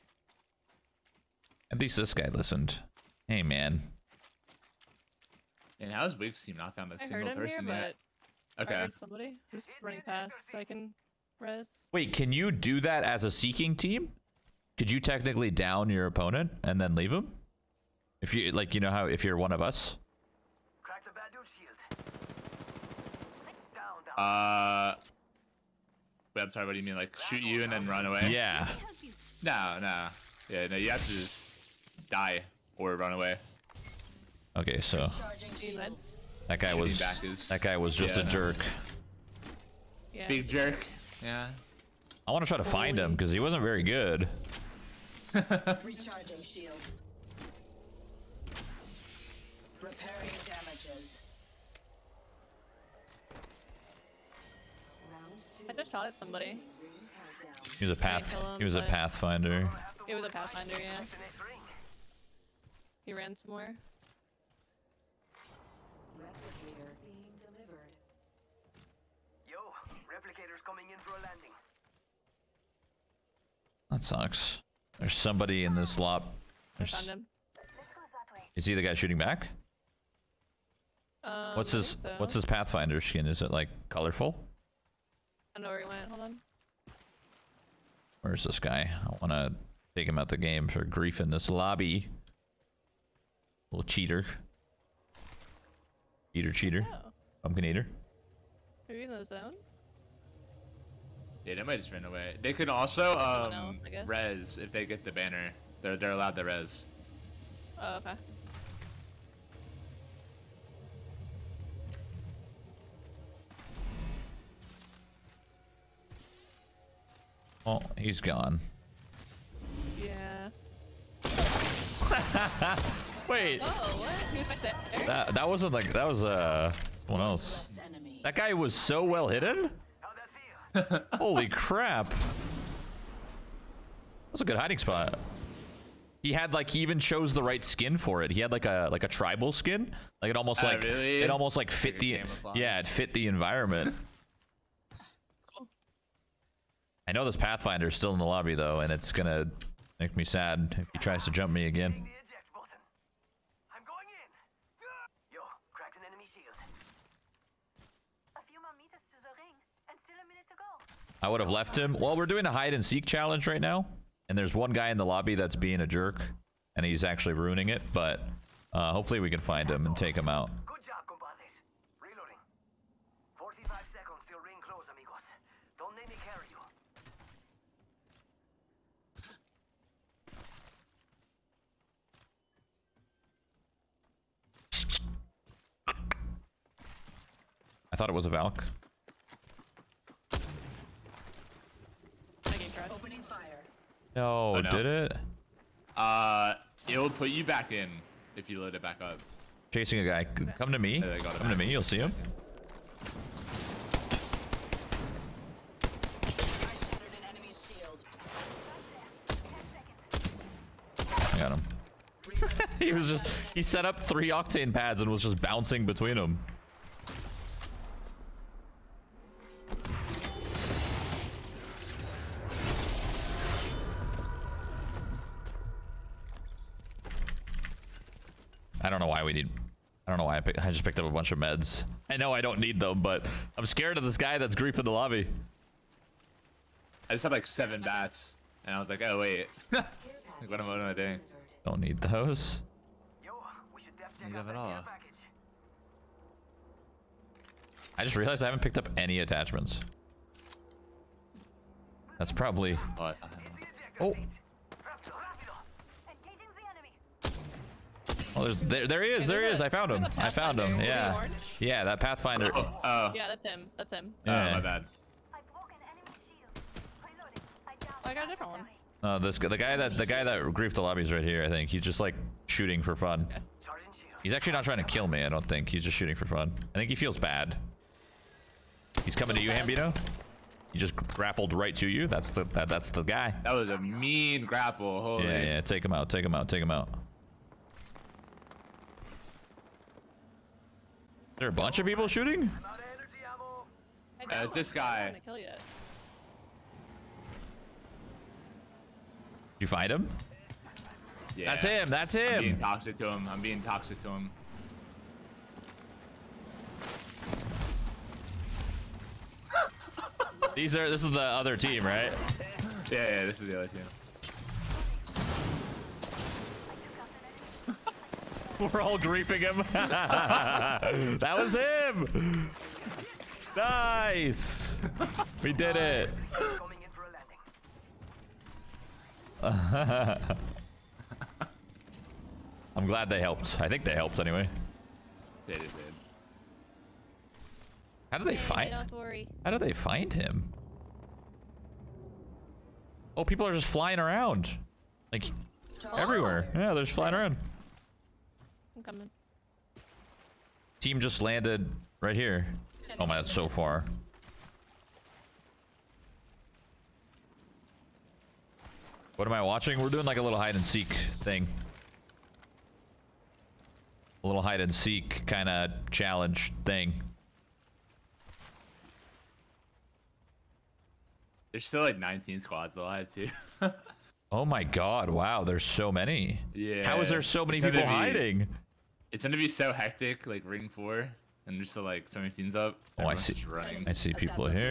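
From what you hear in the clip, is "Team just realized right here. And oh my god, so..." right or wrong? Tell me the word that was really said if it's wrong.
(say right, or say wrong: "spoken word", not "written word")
wrong: "landed", not "realized".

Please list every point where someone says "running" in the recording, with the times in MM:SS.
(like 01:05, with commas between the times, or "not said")
00:09, 06:23.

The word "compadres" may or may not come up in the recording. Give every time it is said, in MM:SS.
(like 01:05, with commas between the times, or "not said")
02:51.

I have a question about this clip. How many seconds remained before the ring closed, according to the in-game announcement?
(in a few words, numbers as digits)
45.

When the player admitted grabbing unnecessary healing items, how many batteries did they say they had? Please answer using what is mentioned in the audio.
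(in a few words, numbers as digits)
7.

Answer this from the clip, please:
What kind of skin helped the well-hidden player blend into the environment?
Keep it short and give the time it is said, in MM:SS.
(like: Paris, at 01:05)
tribal skin, at 02:19.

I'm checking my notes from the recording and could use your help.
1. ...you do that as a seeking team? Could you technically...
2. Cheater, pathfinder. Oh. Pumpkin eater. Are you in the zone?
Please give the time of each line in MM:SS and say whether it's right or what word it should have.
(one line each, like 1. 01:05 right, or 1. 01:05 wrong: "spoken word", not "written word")
1. 00:12 right
2. 01:36 wrong: "cheater", not "pathfinder".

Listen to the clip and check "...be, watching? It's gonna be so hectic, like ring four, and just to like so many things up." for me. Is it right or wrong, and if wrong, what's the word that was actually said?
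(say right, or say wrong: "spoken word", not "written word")
wrong: "hiding", not "watching".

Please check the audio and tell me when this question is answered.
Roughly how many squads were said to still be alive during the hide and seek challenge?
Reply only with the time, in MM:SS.
06:11.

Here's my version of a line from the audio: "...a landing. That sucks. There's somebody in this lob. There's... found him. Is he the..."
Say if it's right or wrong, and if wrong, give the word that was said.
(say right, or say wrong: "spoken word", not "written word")
right.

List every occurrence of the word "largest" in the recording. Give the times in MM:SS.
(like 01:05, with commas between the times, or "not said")
not said.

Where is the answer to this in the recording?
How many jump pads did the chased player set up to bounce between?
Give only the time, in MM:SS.
03:34.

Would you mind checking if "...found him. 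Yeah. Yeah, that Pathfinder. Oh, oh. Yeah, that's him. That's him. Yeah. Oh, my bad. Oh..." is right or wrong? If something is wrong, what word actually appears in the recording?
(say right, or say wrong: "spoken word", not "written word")
right.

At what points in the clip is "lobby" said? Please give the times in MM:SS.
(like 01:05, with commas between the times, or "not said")
01:31, 02:28, 02:45, 03:54, 04:30.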